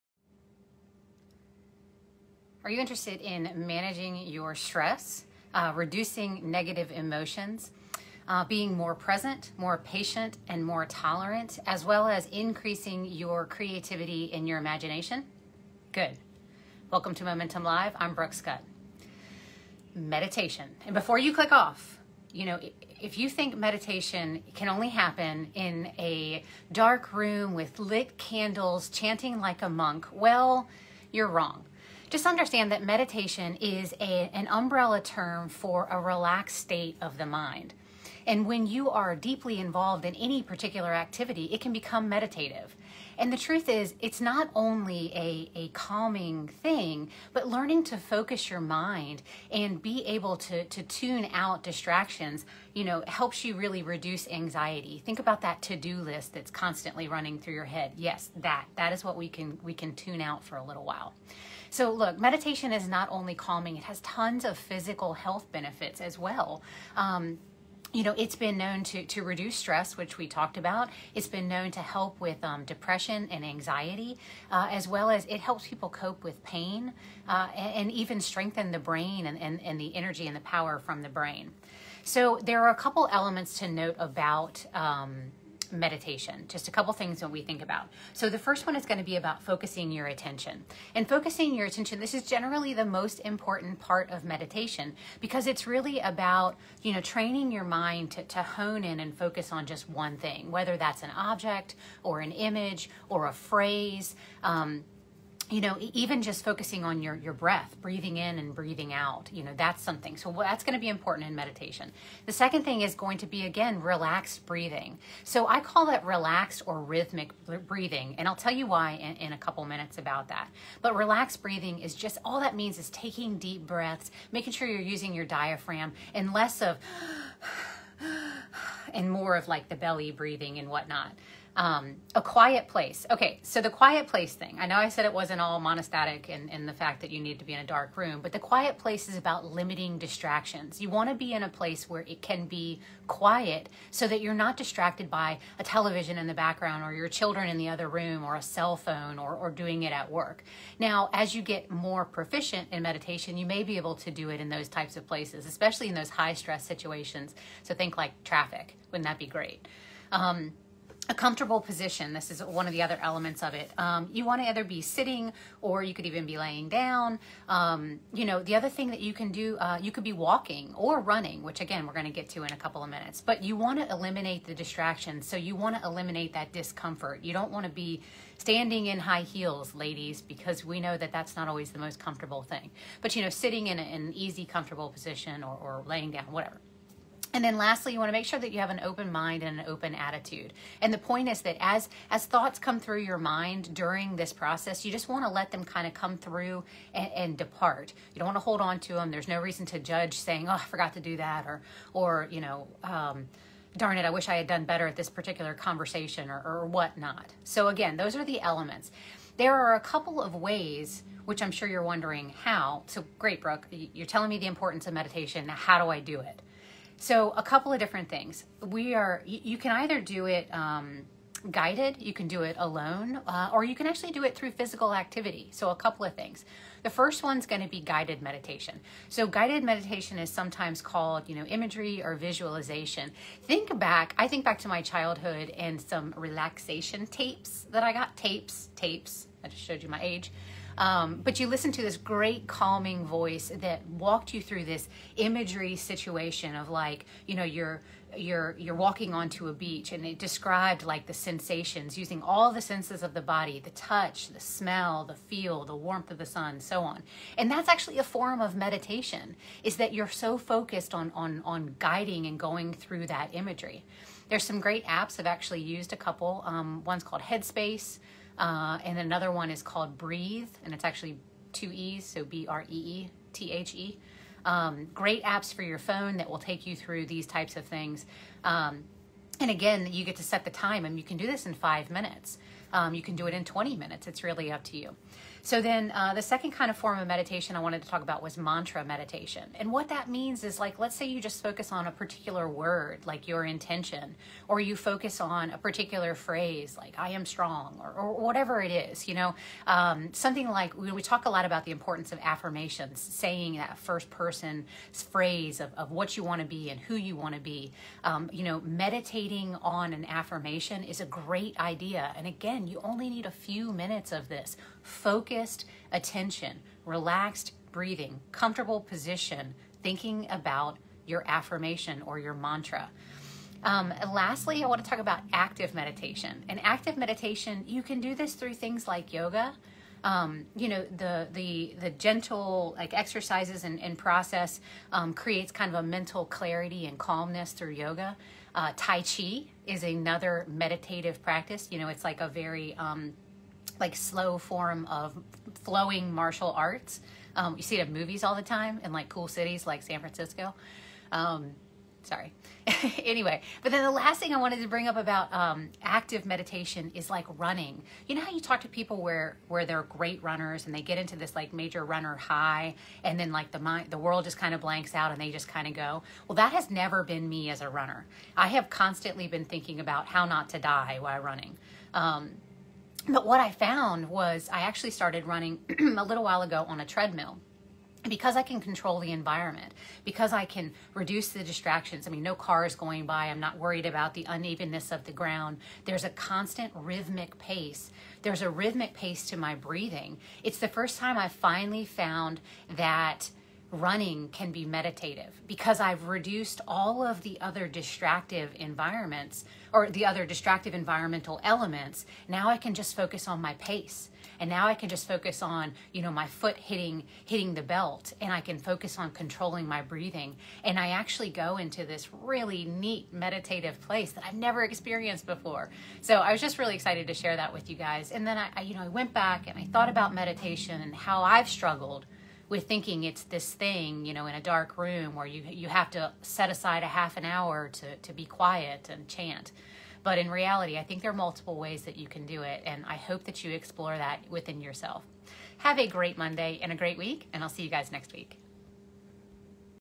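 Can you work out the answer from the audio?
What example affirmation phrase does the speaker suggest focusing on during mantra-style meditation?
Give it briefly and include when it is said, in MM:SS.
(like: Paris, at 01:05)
I am strong, at 04:56.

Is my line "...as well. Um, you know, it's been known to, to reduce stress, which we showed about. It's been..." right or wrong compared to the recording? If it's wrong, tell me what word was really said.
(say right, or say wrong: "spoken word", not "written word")
wrong: "talked", not "showed".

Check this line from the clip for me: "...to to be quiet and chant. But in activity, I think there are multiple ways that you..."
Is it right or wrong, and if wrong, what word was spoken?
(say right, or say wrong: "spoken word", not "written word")
wrong: "reality", not "activity".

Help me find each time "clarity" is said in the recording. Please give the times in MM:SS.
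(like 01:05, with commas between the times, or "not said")
05:36.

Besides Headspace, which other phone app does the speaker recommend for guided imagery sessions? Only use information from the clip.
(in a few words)
Breethe.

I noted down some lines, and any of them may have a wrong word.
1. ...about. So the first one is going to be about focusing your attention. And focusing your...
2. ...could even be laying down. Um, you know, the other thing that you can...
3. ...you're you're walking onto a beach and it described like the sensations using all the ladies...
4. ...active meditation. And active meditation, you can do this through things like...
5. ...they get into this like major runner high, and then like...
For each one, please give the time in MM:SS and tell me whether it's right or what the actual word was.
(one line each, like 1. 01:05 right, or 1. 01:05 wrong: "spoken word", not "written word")
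1. 01:27 right
2. 02:45 right
3. 04:08 wrong: "senses", not "ladies"
4. 05:25 right
5. 06:00 right.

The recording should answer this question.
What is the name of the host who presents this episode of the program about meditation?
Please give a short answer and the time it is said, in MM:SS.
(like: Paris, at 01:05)
Brooke Scutt, at 00:18.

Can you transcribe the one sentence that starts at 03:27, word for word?
So, again, those are the elements.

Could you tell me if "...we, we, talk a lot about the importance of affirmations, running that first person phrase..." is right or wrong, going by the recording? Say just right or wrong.
wrong.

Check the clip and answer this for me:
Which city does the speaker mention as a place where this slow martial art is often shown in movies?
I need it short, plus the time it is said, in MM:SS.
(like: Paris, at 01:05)
San Francisco, at 05:49.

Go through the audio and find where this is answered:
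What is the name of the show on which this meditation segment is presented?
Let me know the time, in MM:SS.
00:17.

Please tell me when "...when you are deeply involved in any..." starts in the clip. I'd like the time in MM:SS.
00:38.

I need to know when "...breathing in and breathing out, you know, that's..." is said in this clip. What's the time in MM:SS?
01:47.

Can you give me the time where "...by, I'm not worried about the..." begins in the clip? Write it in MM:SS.
06:23.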